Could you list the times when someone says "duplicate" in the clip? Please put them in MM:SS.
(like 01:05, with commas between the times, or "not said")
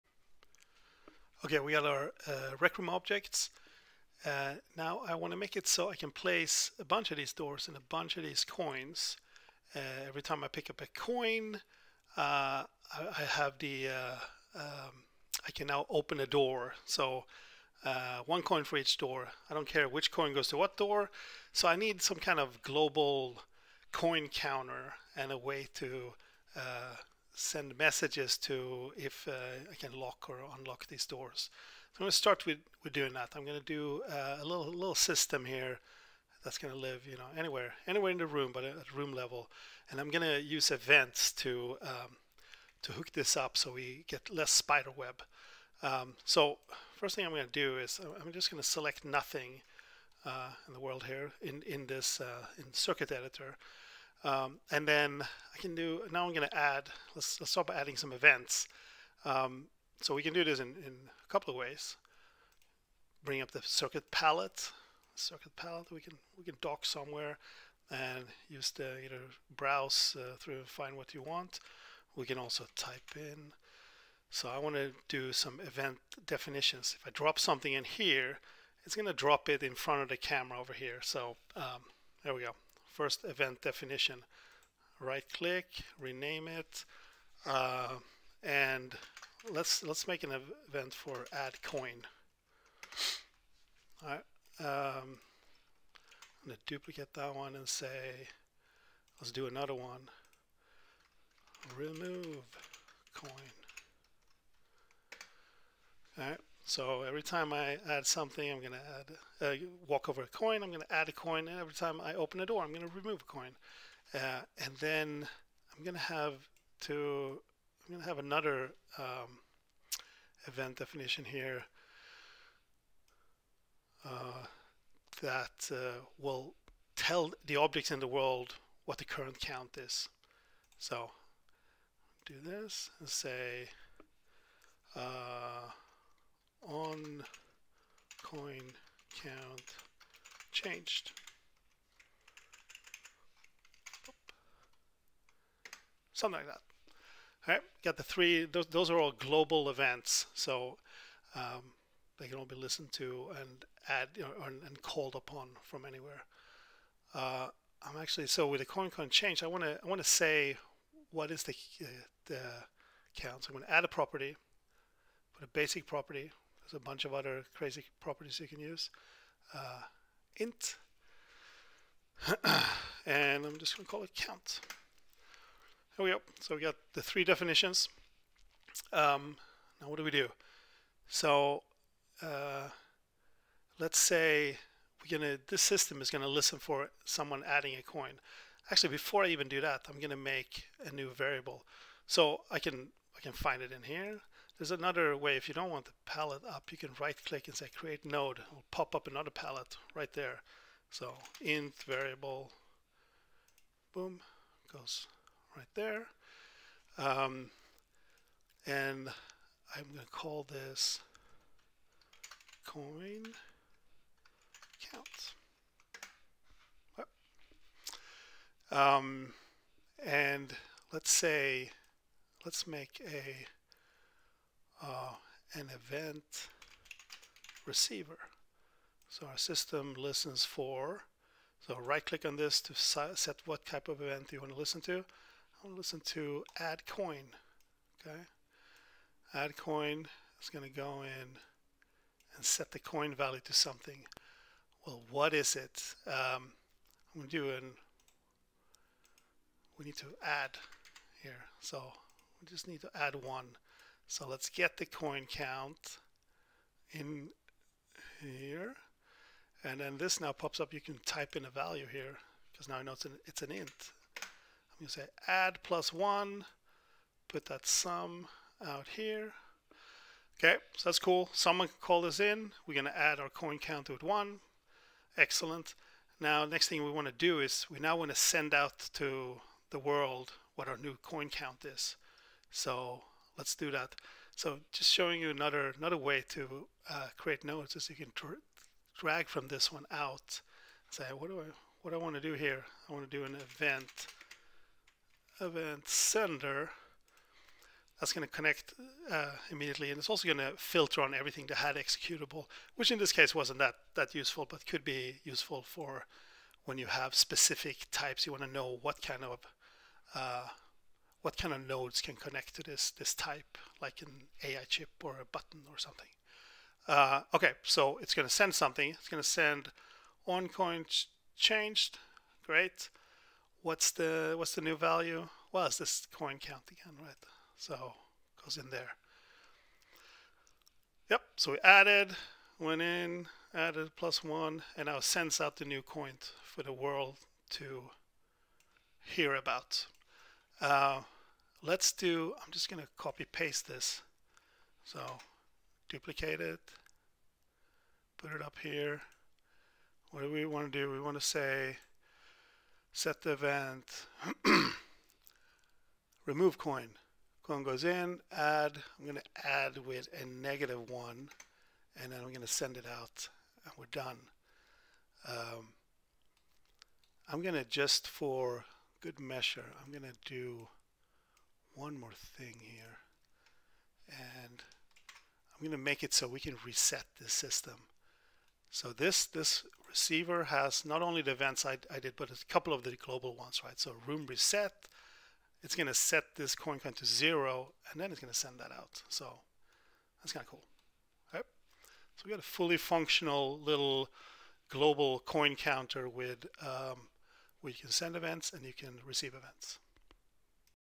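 01:36, 05:45.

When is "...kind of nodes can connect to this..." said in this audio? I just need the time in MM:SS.
05:11.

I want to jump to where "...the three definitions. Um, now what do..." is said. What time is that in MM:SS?
02:56.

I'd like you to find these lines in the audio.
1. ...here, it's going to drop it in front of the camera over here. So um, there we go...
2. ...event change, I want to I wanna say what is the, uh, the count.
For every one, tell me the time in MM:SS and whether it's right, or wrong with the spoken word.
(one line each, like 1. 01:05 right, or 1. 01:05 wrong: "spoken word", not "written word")
1. 01:17 right
2. 02:38 wrong: "count", not "event".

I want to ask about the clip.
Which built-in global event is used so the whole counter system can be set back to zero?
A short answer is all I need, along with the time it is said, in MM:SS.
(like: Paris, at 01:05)
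room reset, at 06:24.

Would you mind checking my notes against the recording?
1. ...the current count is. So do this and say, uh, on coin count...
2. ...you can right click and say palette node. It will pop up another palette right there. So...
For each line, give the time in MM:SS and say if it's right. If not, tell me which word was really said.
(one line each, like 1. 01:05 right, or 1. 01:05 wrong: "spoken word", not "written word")
1. 02:08 right
2. 03:16 wrong: "create", not "palette".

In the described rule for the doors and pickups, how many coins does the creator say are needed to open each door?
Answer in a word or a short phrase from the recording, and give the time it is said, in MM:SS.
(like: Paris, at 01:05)
1, at 00:18.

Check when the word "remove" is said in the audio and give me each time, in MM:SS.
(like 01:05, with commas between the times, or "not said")
01:41, 01:52, 05:56.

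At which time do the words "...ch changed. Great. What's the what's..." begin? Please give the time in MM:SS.
05:20.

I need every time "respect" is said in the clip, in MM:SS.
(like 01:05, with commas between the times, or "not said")
not said.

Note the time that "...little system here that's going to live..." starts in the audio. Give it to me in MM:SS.
00:34.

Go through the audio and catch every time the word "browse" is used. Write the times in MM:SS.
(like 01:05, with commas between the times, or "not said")
01:09.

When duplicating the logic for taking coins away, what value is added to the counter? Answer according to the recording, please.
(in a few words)
negative one.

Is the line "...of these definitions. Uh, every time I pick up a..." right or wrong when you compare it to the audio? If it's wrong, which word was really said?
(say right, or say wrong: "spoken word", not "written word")
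wrong: "coins", not "definitions".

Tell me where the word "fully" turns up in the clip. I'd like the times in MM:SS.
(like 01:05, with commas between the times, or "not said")
06:32.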